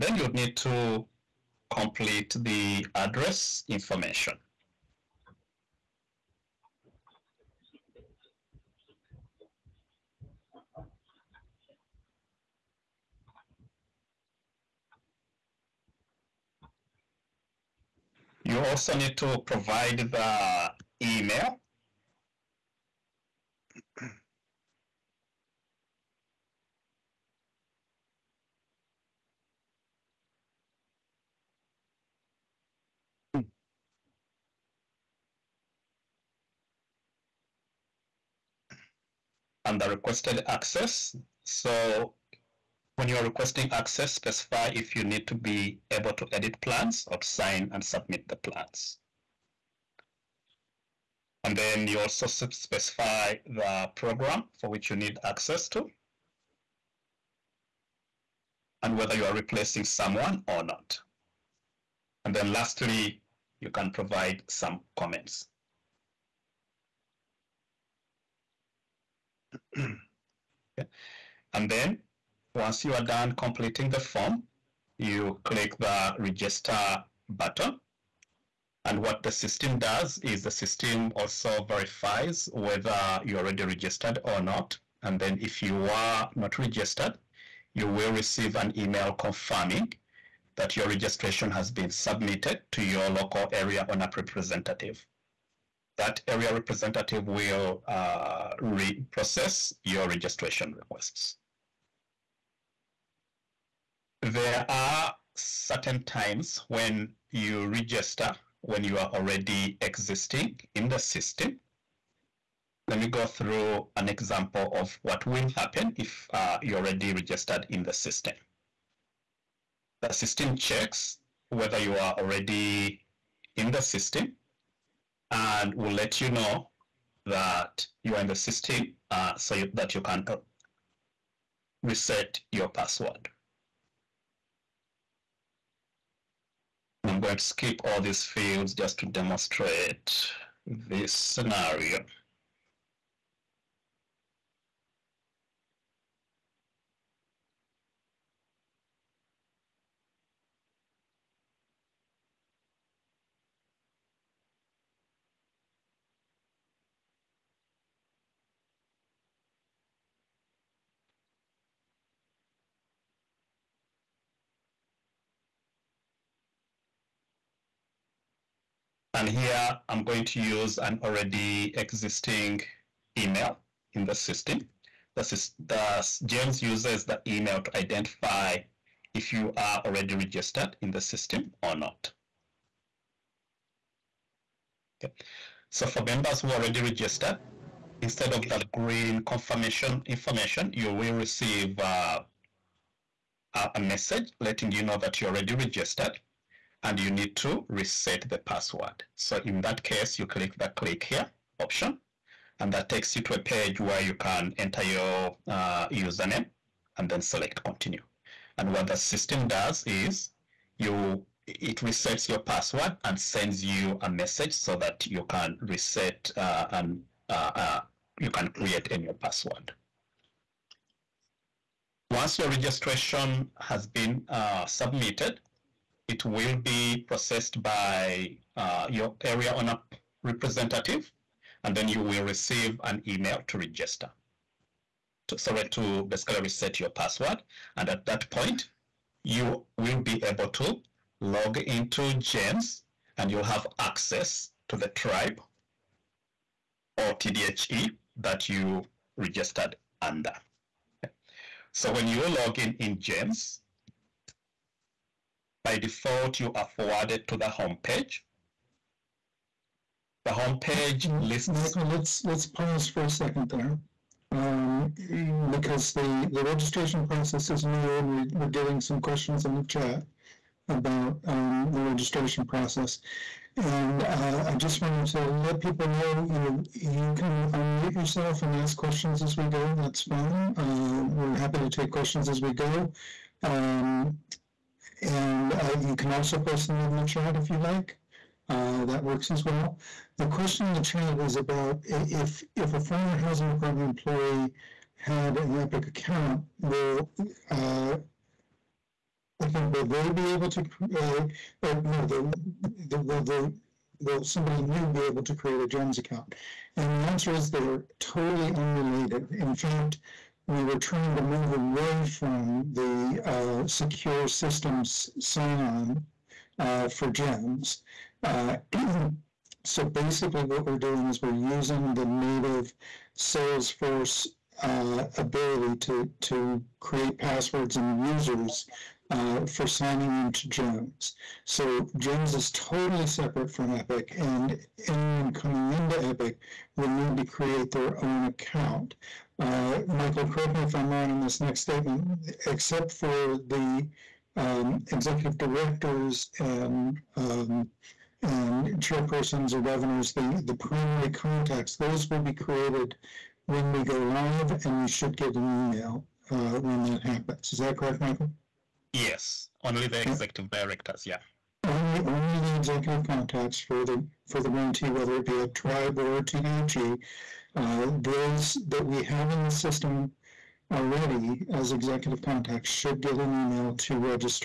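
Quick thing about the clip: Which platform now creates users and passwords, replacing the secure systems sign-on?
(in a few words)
Salesforce.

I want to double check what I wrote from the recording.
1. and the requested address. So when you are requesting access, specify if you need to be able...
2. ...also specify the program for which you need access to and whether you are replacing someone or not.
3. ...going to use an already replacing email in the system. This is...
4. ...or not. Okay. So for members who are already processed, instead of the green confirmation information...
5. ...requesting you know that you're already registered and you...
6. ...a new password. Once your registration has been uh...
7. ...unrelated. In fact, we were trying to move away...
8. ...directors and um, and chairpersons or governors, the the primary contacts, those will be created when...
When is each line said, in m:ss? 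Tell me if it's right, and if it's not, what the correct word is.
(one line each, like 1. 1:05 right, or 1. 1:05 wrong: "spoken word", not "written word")
1. 0:39 wrong: "access", not "address"
2. 0:51 right
3. 2:50 wrong: "existing", not "replacing"
4. 3:01 wrong: "registered", not "processed"
5. 3:14 wrong: "letting", not "requesting"
6. 3:38 right
7. 5:08 right
8. 5:45 right.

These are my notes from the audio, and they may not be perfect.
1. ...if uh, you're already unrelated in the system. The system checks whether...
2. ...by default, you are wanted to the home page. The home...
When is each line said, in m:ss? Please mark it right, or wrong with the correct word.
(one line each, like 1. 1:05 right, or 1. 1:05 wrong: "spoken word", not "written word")
1. 1:55 wrong: "registered", not "unrelated"
2. 4:15 wrong: "forwarded", not "wanted".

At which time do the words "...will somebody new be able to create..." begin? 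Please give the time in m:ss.
5:04.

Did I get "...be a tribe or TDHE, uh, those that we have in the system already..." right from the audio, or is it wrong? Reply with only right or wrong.
right.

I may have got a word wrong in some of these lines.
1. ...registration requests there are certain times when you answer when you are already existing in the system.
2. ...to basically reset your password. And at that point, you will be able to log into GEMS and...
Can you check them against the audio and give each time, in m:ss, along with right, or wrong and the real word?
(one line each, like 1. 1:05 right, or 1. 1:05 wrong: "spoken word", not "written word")
1. 1:40 wrong: "register", not "answer"
2. 3:55 right.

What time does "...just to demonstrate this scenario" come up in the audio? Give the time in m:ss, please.
2:18.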